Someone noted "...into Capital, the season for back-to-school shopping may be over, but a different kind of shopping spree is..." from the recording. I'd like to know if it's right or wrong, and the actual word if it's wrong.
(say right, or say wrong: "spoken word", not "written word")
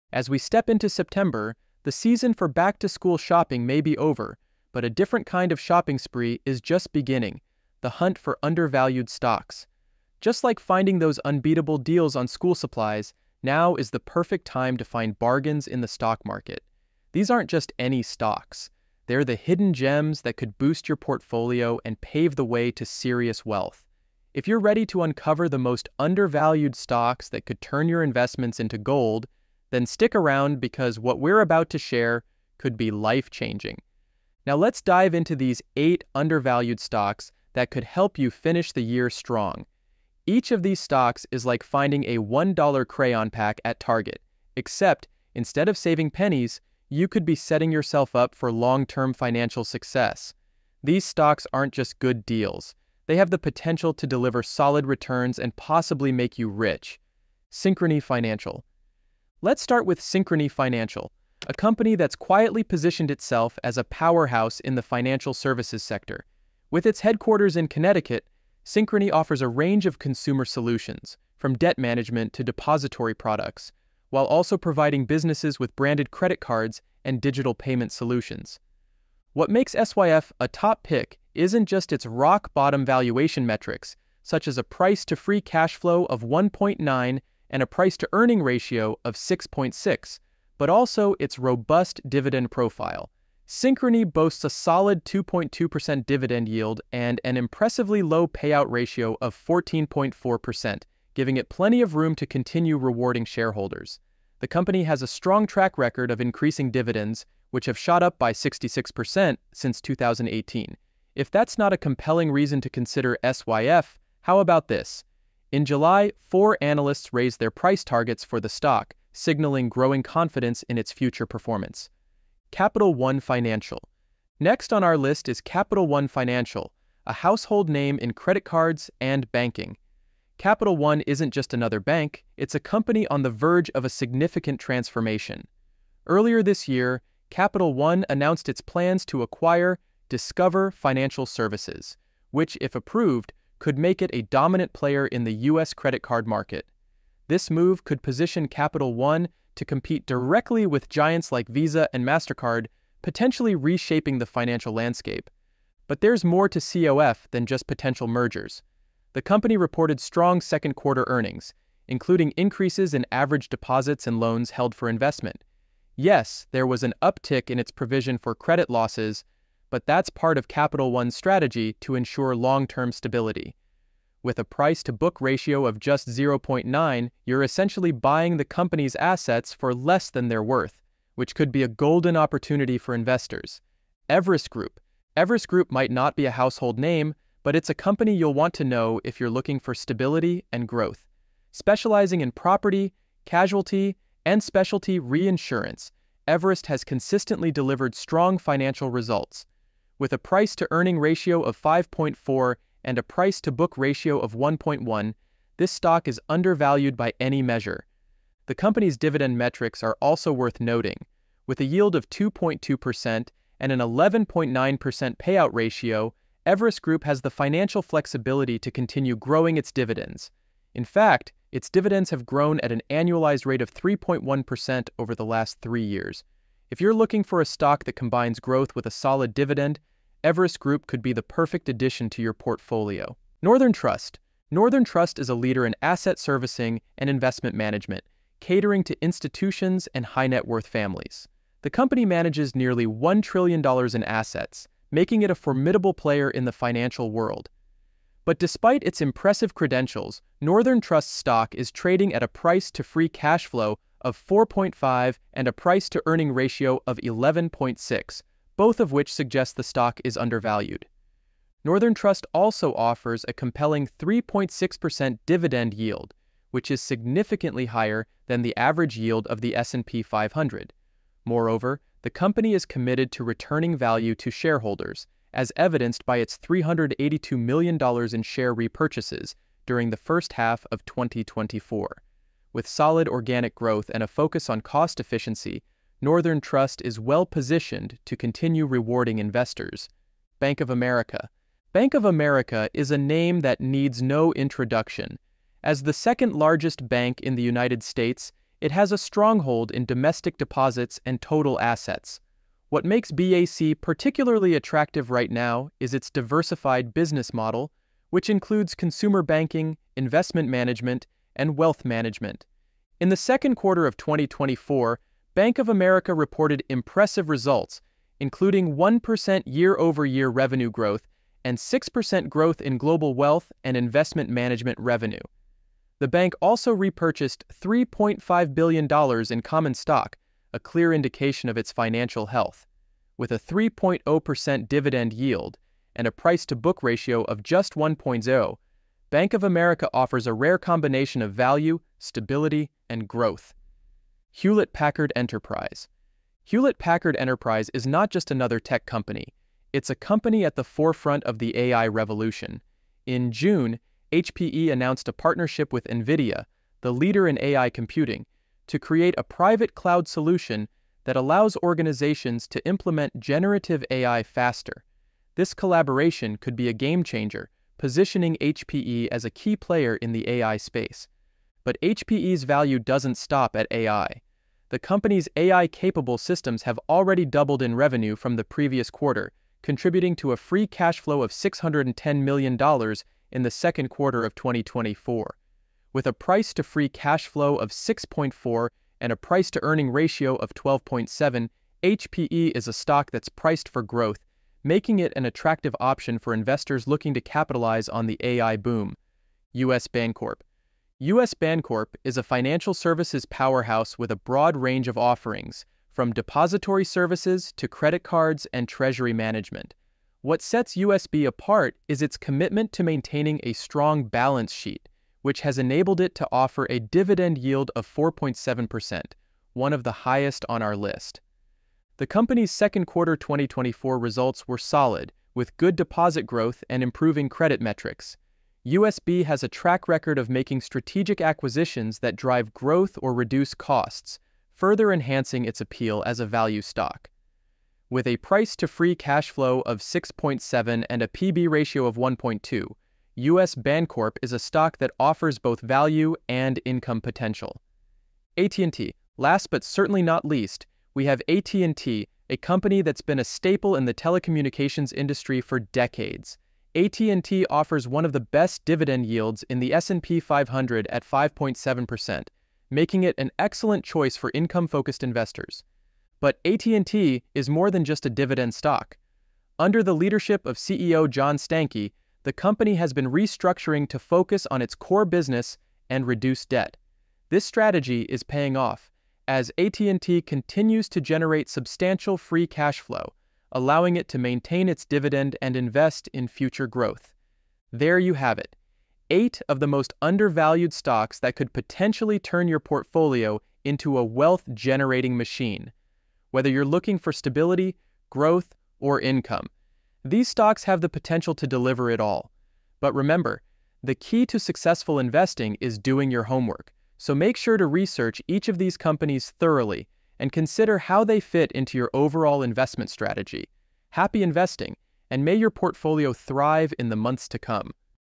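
wrong: "September", not "Capital".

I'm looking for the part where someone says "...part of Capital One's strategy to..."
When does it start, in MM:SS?
02:50.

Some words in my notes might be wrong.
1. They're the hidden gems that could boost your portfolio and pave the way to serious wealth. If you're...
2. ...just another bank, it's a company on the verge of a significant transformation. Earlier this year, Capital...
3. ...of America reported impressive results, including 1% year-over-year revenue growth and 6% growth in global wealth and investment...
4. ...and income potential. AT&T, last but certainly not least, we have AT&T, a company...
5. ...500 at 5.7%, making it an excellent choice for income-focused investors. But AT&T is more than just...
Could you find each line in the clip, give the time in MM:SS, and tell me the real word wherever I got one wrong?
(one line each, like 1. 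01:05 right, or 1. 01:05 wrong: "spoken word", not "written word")
1. 00:19 right
2. 02:11 right
3. 05:15 right
4. 07:26 right
5. 07:40 right.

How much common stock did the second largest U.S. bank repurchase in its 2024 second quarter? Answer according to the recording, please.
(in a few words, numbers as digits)
$3.5 billion.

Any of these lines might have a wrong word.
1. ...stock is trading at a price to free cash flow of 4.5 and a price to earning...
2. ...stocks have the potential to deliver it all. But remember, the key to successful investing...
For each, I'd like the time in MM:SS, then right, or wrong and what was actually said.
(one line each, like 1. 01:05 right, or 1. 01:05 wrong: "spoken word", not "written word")
1. 04:11 right
2. 08:20 right.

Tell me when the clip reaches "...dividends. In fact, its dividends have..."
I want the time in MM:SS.
03:39.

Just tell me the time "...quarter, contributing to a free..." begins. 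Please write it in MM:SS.
06:18.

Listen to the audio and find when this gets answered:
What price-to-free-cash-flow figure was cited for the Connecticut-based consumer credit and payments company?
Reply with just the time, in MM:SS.
01:26.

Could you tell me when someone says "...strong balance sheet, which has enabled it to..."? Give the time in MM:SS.
06:53.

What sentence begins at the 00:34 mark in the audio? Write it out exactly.
Now let's dive into these eight undervalued stocks that could help you finish the year strong.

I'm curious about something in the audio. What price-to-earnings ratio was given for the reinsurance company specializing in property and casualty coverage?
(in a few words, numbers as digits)
5.4.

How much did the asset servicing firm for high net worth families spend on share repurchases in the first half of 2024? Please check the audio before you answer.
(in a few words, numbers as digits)
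$382 million.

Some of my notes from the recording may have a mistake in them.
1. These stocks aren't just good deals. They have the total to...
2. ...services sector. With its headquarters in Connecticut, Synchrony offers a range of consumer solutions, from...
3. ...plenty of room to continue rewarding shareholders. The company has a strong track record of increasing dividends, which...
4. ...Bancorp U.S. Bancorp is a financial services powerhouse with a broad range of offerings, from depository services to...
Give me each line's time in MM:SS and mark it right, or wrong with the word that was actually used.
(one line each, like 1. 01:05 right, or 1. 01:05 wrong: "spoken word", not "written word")
1. 00:50 wrong: "potential", not "total"
2. 01:05 right
3. 01:41 right
4. 06:39 right.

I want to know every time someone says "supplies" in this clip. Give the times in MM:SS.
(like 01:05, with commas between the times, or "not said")
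00:12.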